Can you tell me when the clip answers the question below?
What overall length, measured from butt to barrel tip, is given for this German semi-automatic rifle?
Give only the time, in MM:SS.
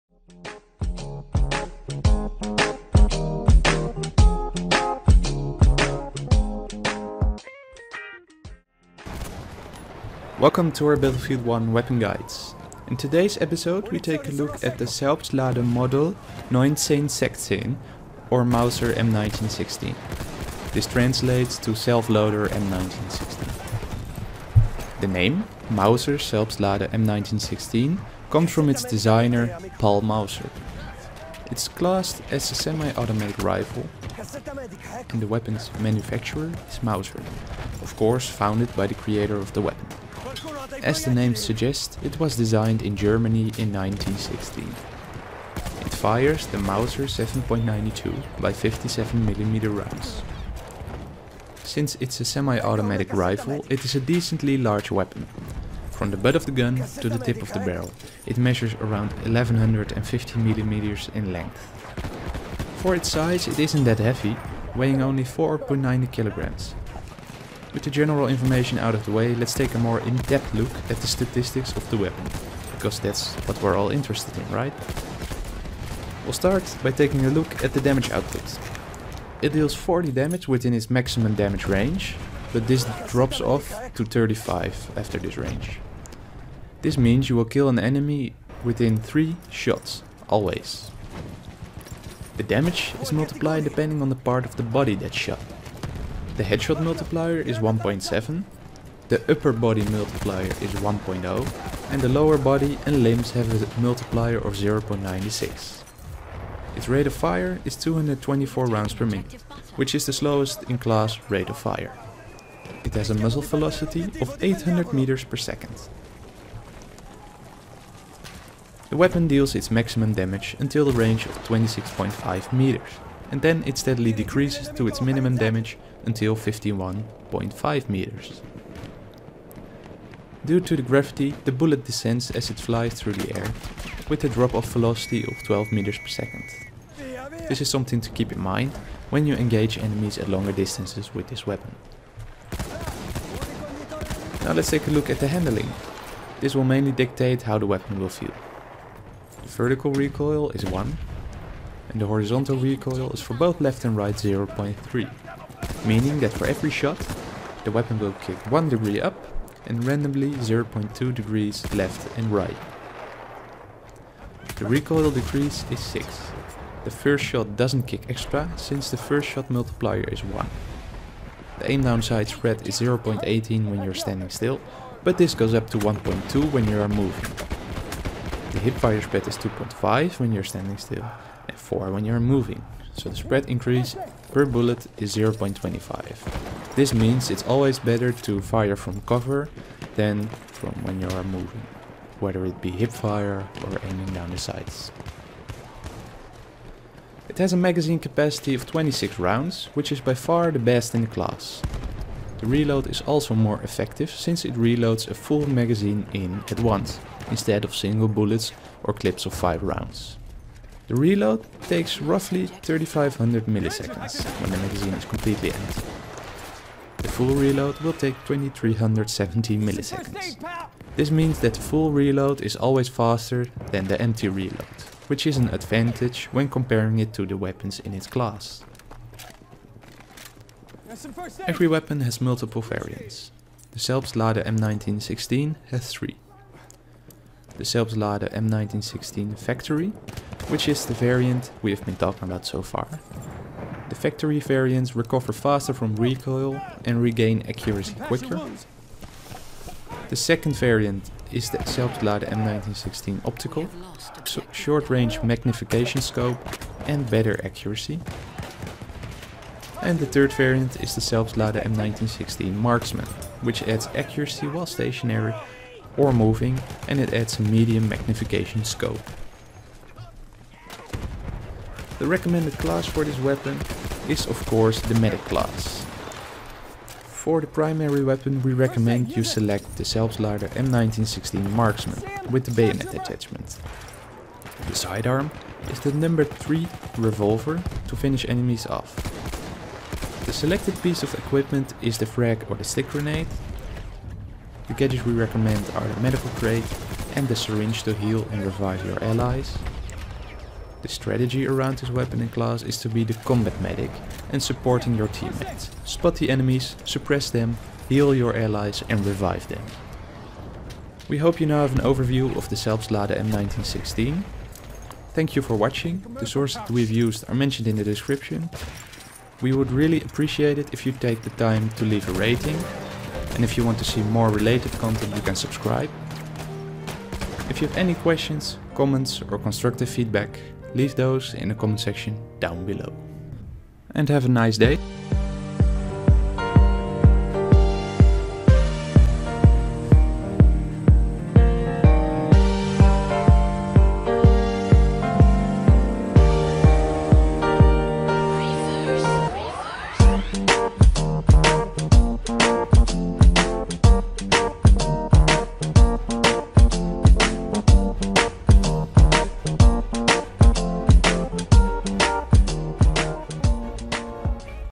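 00:59.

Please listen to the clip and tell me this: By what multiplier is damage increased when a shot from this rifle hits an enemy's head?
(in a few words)
1.7.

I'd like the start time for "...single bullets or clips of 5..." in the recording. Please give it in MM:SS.
03:27.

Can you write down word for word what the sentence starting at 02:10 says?
Due to the gravity, the bullet descends as it flies through the air, with a drop-off velocity of 12 meters per second.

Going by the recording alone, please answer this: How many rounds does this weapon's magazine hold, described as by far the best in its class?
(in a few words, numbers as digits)
26.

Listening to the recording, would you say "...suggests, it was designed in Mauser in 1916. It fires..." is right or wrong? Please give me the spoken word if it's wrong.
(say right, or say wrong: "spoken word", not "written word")
wrong: "Germany", not "Mauser".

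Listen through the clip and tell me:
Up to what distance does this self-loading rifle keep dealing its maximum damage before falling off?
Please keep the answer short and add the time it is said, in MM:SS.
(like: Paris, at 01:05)
26.5 meters, at 02:01.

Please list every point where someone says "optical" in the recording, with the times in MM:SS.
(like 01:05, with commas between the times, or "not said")
04:13.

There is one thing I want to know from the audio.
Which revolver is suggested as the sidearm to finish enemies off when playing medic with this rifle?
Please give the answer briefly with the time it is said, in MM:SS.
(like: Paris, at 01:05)
Number 3 revolver, at 04:45.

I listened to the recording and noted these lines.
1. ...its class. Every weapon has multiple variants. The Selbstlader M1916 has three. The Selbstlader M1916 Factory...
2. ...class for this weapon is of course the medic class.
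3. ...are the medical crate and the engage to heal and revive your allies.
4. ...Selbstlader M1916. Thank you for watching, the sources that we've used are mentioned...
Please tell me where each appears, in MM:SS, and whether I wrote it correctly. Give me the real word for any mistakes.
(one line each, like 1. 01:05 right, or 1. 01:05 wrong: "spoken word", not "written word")
1. 03:47 right
2. 04:32 right
3. 04:55 wrong: "syringe", not "engage"
4. 05:12 right.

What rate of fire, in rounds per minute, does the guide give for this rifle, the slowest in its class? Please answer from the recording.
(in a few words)
224.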